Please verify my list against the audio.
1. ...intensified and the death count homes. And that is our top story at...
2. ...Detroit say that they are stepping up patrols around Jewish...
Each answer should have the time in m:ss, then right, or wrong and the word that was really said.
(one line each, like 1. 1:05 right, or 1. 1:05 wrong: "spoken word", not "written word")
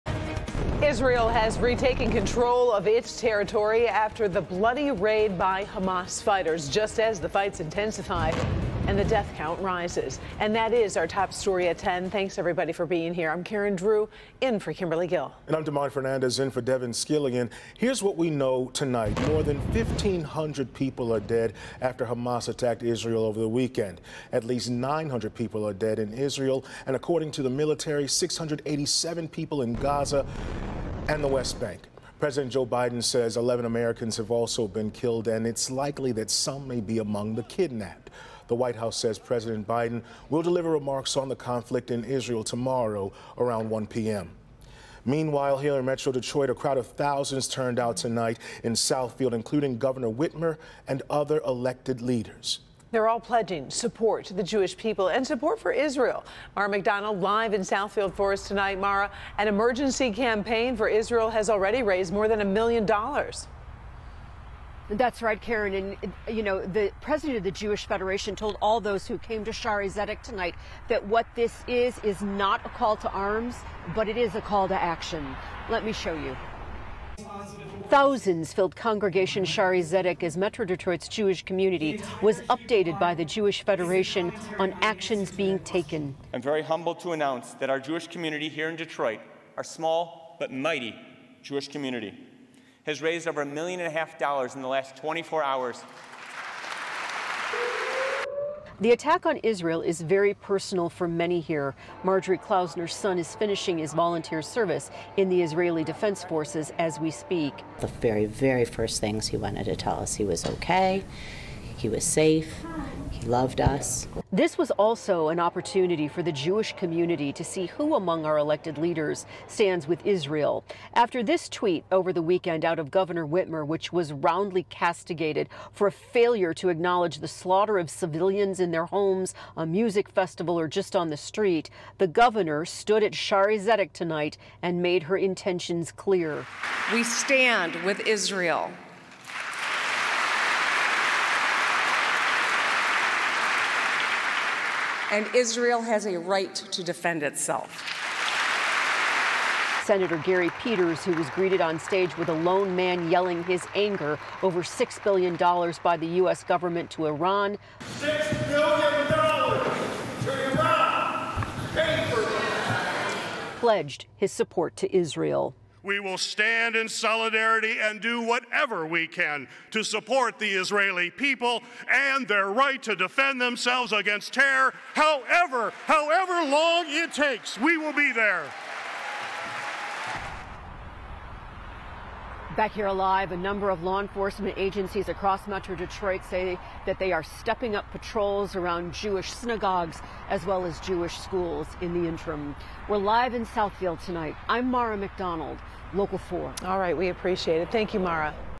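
1. 0:07 wrong: "rises", not "homes"
2. 3:05 right.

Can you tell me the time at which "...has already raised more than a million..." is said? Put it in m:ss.
1:01.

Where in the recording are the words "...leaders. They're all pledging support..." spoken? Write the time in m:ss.
0:52.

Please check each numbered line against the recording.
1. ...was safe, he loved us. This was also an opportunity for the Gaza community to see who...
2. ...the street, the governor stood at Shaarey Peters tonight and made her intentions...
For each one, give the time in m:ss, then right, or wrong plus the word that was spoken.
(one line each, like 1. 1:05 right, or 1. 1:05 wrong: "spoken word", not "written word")
1. 1:51 wrong: "Jewish", not "Gaza"
2. 2:11 wrong: "Zedek", not "Peters".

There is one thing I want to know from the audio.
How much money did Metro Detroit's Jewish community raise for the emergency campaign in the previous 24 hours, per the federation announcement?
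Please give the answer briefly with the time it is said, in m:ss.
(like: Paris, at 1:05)
Over $1.5 million, at 1:33.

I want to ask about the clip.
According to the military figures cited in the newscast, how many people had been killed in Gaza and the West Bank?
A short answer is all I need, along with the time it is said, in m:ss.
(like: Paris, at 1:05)
687, at 0:28.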